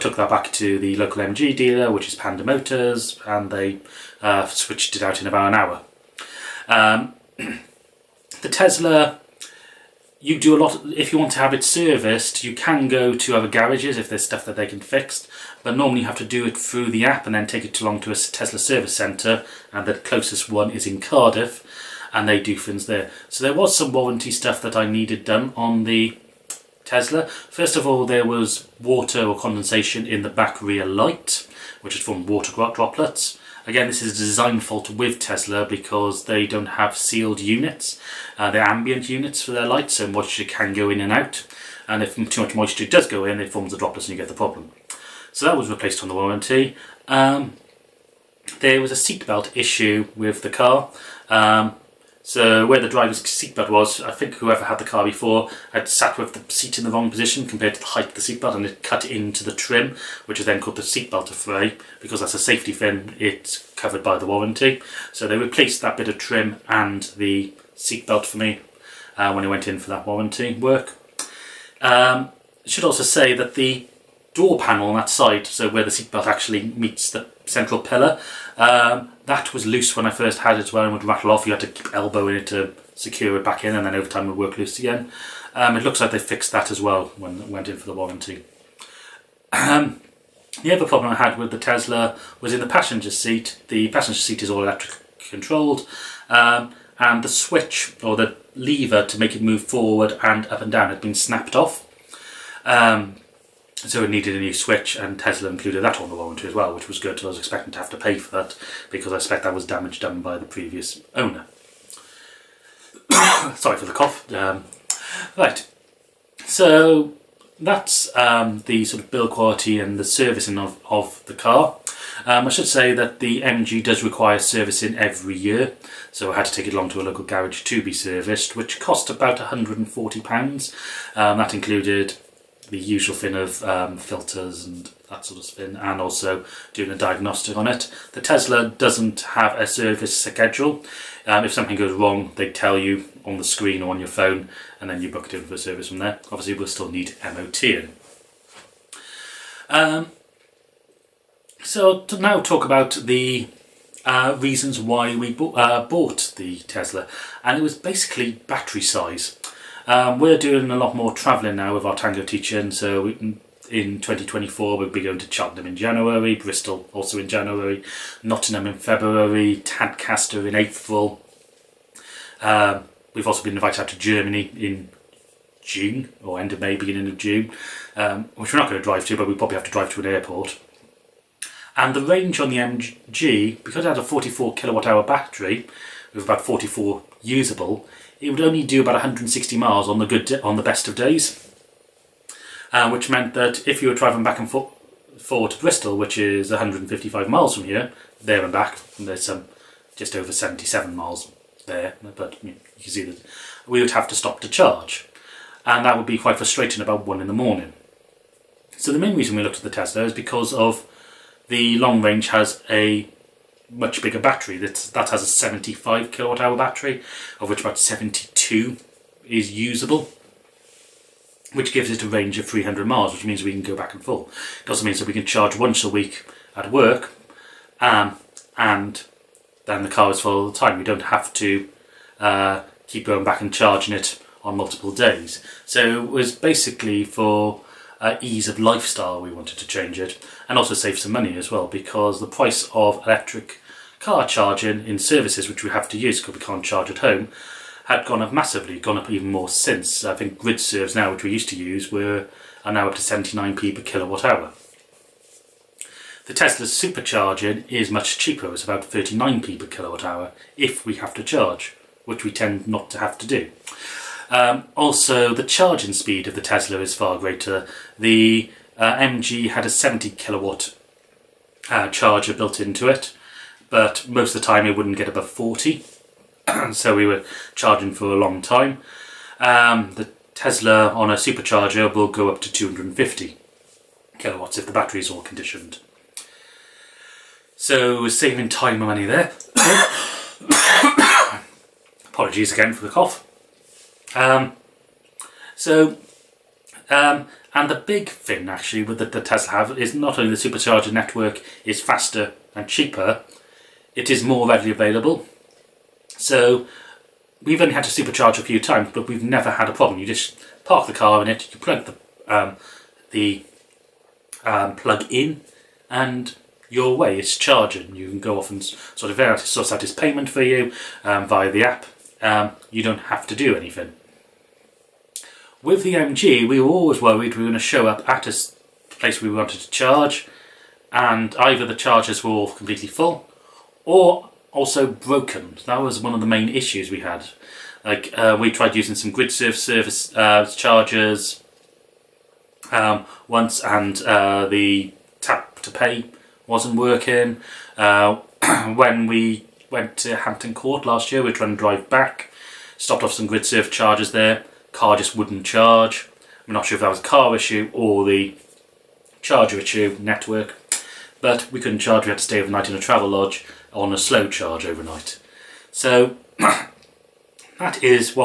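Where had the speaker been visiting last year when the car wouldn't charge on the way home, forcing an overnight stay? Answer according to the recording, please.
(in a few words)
Hampton Court.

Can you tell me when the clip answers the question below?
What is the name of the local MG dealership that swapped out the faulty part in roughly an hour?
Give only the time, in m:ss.
0:02.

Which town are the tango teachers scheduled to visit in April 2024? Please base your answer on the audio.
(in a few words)
Tadcaster.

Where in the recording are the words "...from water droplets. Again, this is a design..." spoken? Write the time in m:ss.
0:32.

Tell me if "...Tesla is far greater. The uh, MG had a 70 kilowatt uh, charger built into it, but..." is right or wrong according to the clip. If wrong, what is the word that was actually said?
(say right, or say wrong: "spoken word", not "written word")
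right.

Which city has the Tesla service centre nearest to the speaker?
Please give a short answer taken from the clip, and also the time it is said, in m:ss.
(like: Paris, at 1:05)
Cardiff, at 0:20.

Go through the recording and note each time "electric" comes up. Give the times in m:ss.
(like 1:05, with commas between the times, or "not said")
1:34, 4:03.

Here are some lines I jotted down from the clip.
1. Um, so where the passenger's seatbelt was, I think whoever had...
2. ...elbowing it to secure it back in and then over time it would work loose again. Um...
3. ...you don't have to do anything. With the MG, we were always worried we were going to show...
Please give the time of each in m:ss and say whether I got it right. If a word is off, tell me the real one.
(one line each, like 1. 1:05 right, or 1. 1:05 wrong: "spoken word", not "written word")
1. 0:51 wrong: "driver", not "passenger"
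2. 1:21 right
3. 5:22 right.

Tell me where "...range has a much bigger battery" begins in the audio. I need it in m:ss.
3:32.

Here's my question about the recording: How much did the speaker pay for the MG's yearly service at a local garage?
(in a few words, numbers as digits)
£140.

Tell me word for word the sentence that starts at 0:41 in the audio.
And if too much moisture does go in, it forms the droplets and you get the problem.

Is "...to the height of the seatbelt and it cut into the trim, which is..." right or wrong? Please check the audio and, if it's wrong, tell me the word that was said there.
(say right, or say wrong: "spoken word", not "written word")
right.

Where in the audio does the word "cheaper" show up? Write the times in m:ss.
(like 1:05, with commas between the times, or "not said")
4:18, 5:02.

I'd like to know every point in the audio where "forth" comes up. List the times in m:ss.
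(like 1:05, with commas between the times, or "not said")
3:14, 3:44.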